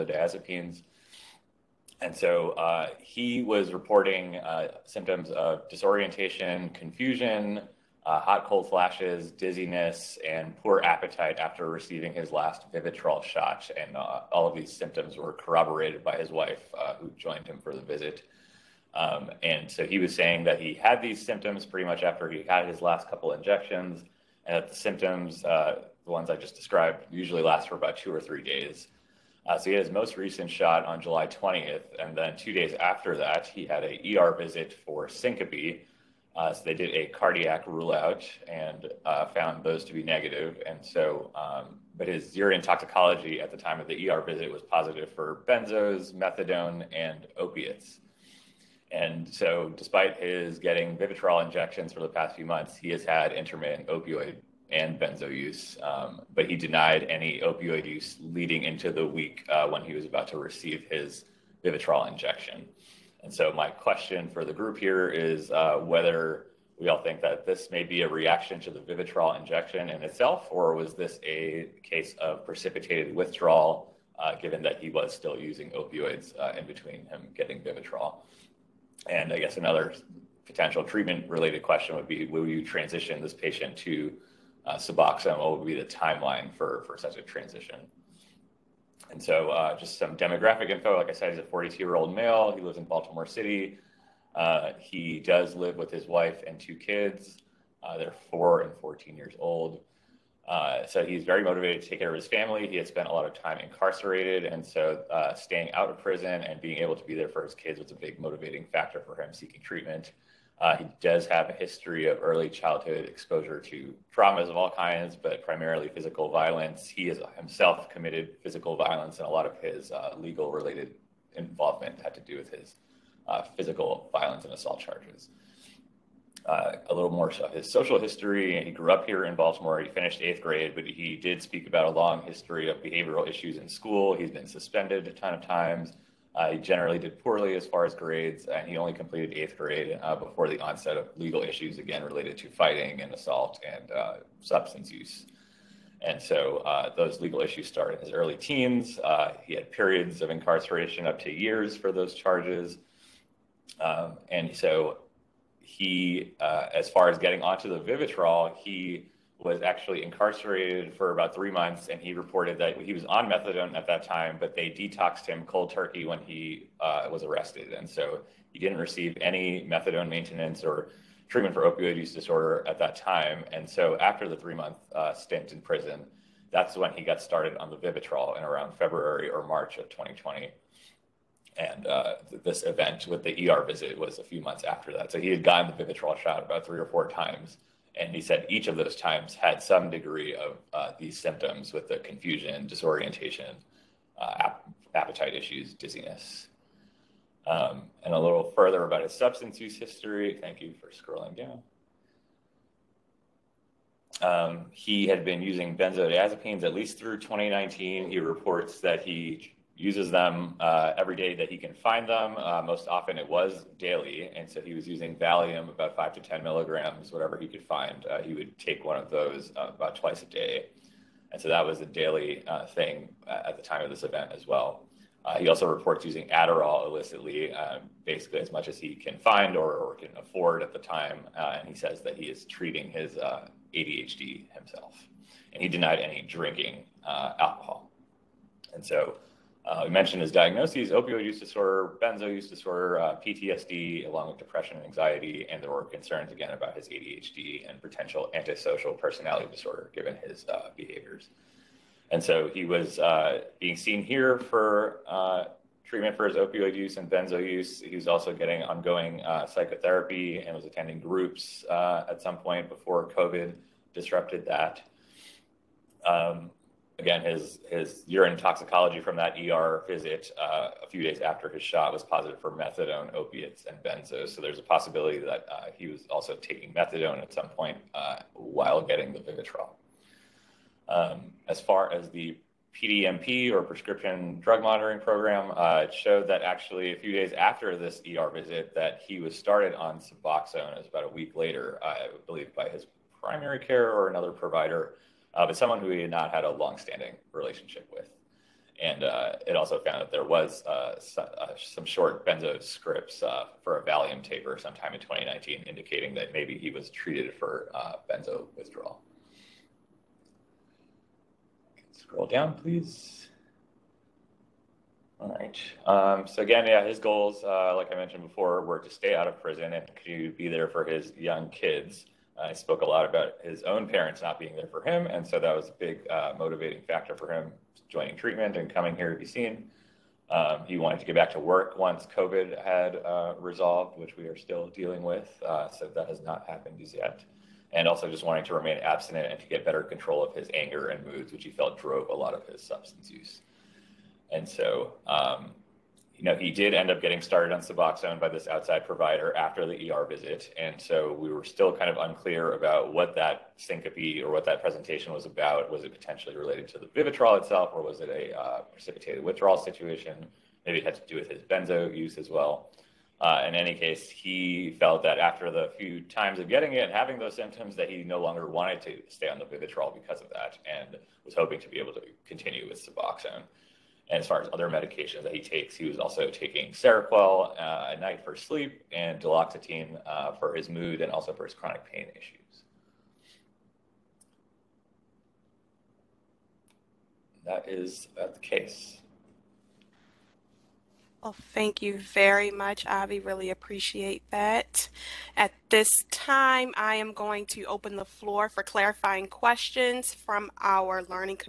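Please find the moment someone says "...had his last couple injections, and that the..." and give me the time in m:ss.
0:22.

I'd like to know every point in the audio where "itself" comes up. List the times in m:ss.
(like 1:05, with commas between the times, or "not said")
1:10, 5:57.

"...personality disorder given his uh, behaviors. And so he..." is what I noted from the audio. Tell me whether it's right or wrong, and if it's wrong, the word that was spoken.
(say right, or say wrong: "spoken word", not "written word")
right.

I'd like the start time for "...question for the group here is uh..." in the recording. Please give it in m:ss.
1:03.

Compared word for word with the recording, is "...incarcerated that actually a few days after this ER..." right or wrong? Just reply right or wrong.
wrong.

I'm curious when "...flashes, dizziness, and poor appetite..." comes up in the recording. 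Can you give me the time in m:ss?
0:08.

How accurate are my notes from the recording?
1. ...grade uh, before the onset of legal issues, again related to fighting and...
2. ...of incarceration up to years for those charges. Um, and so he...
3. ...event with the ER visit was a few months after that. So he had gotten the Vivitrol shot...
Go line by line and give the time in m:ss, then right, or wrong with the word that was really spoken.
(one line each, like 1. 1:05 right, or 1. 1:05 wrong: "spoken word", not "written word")
1. 2:19 right
2. 2:30 right
3. 3:02 right.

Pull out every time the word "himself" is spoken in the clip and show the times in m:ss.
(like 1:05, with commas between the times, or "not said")
1:57, 3:54.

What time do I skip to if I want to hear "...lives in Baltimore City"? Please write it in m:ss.
1:32.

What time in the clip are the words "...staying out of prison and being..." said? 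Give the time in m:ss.
1:45.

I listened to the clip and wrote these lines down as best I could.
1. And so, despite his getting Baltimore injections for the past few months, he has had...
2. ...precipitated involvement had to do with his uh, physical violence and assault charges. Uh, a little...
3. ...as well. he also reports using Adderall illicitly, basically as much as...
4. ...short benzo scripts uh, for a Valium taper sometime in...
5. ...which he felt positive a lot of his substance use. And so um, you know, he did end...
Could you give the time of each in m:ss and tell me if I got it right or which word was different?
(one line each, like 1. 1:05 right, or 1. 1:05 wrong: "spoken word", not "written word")
1. 0:48 wrong: "Vivitrol", not "Baltimore"
2. 2:00 wrong: "related", not "precipitated"
3. 3:44 right
4. 5:01 right
5. 5:41 wrong: "drove", not "positive".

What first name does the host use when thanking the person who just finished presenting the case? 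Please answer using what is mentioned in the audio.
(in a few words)
Avi.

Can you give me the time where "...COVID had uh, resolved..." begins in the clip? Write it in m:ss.
5:32.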